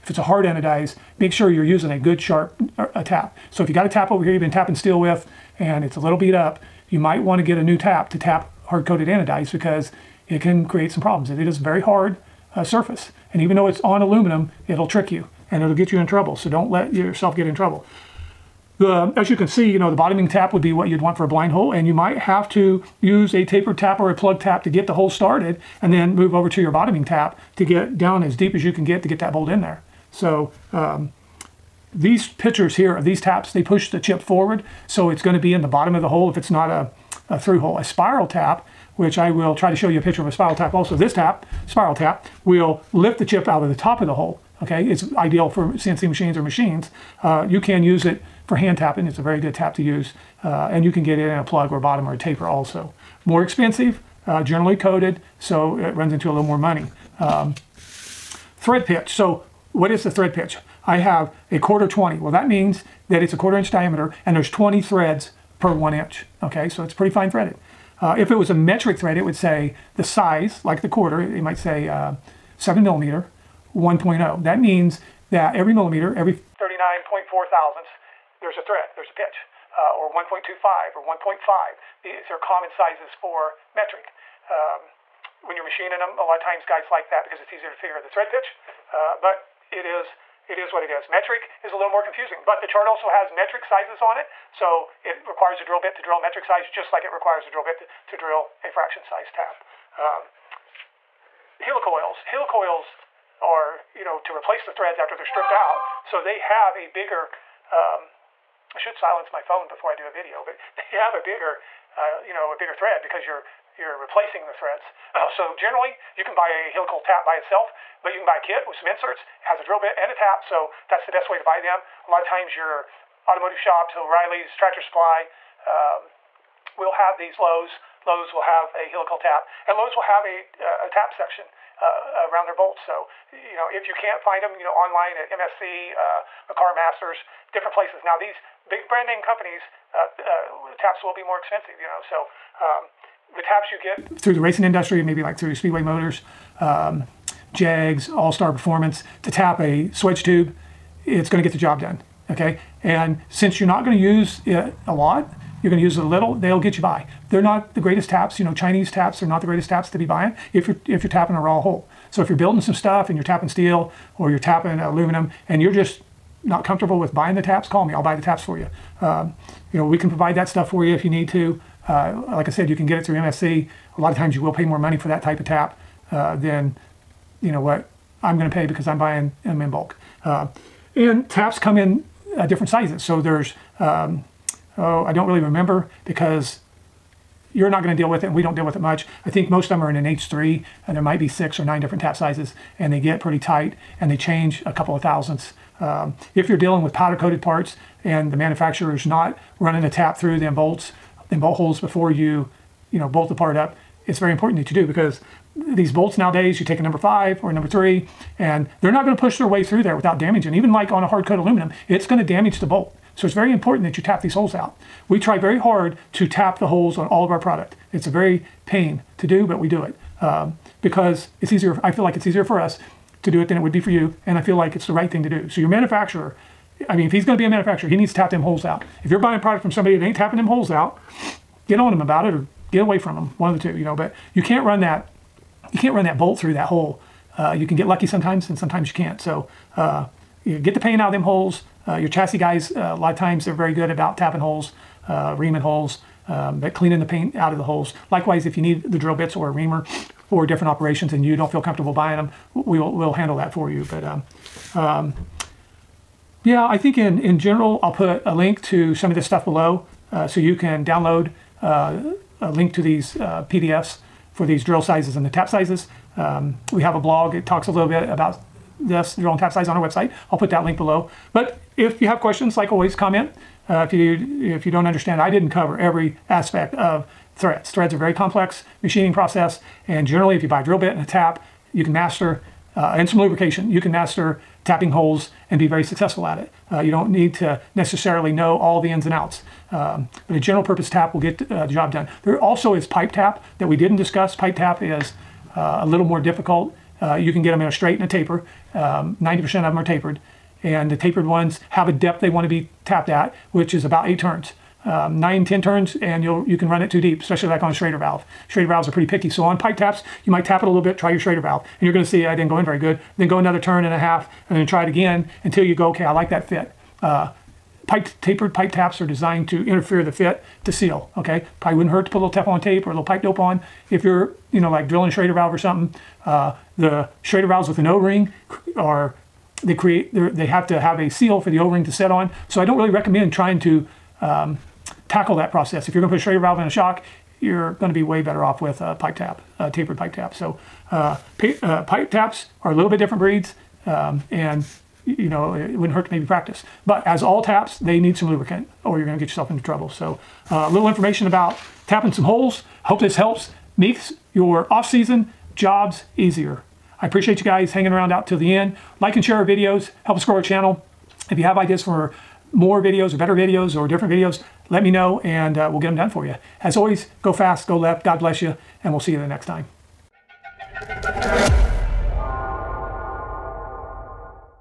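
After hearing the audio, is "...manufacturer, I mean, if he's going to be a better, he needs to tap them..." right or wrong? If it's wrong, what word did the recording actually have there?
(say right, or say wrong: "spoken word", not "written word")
wrong: "manufacturer", not "better".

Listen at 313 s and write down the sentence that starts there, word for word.
Then go another turn and a half, and then try it again until you go, okay, I like that fit.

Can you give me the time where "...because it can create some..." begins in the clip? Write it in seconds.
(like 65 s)
9 s.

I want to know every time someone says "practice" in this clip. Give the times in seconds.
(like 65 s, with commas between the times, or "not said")
346 s.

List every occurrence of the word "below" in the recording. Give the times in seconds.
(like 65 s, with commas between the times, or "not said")
259 s, 270 s.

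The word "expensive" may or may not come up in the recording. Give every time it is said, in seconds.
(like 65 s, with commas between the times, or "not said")
53 s, 141 s.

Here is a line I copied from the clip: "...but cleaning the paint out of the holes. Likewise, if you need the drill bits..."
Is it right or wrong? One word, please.
right.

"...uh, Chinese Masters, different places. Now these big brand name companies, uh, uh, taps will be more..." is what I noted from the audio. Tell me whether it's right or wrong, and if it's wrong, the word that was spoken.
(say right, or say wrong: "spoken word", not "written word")
wrong: "McCar", not "Chinese".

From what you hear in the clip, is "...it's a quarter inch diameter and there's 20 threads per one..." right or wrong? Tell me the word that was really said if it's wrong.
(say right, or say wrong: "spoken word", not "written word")
right.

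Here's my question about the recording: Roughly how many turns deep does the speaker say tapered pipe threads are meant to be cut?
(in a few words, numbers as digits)
8 turns.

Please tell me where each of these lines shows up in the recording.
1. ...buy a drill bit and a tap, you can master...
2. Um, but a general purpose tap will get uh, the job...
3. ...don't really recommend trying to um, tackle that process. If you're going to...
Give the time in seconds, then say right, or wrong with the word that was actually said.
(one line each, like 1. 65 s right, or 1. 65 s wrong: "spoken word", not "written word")
1. 280 s right
2. 289 s right
3. 332 s right.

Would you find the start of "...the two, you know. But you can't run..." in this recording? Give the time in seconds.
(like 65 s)
233 s.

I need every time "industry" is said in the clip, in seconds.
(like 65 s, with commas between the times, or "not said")
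144 s.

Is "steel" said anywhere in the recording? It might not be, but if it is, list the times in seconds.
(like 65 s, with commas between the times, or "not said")
4 s, 163 s.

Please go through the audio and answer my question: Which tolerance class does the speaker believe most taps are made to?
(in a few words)
H3.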